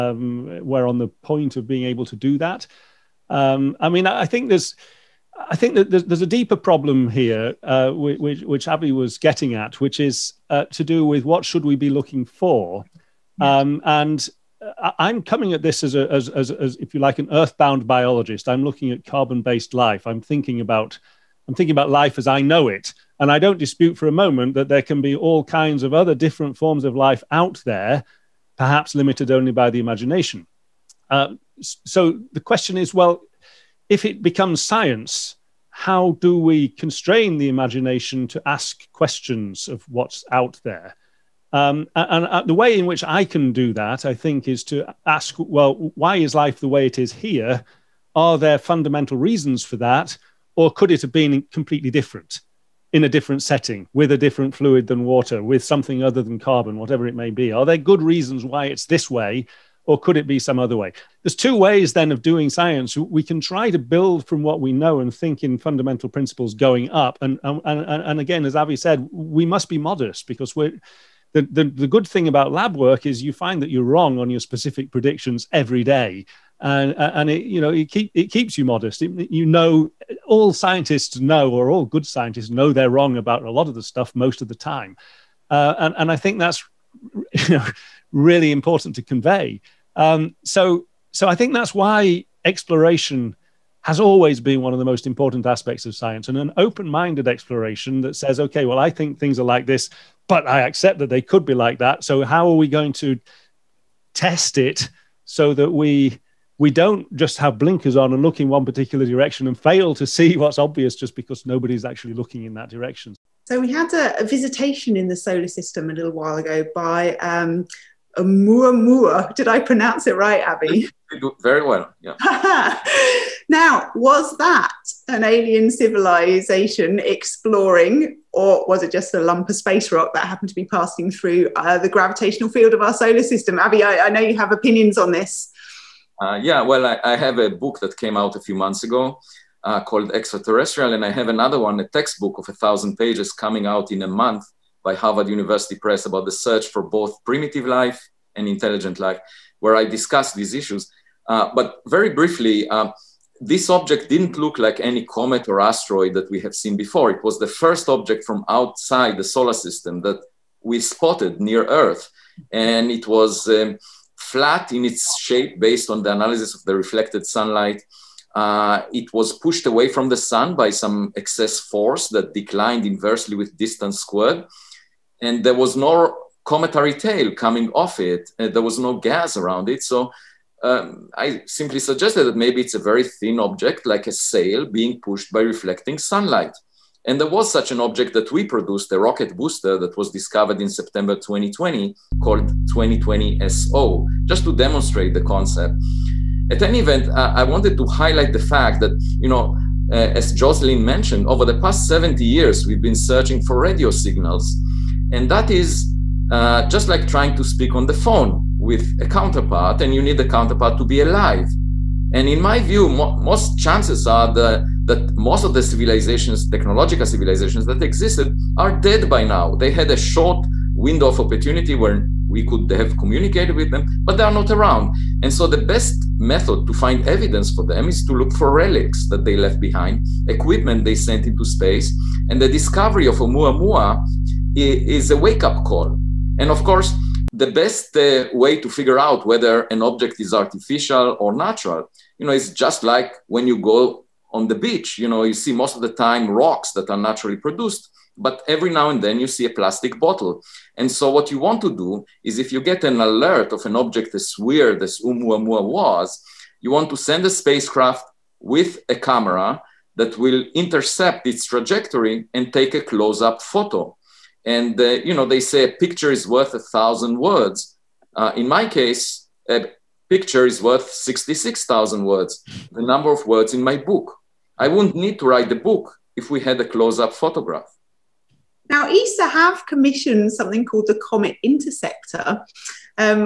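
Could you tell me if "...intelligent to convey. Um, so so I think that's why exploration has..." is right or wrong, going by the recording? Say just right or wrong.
wrong.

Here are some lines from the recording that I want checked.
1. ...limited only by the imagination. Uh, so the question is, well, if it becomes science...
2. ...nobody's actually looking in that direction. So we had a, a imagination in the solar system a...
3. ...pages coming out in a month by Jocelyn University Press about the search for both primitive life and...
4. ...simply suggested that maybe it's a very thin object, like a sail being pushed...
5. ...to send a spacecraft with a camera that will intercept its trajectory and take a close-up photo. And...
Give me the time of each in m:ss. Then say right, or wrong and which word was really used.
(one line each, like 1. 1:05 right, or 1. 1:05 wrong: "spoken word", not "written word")
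1. 0:28 right
2. 1:51 wrong: "visitation", not "imagination"
3. 2:22 wrong: "Harvard", not "Jocelyn"
4. 3:01 right
5. 4:16 right.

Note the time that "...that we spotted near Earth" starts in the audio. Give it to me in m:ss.
2:40.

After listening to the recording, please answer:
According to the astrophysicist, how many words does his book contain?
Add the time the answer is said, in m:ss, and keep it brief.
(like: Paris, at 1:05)
66,000, at 4:30.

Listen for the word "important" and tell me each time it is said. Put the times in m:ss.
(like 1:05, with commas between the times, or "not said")
1:28, 1:35.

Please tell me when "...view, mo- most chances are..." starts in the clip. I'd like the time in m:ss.
3:32.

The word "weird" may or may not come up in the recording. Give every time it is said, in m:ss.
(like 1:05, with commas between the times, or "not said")
4:14.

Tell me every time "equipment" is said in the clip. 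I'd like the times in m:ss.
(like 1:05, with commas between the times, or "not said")
3:50.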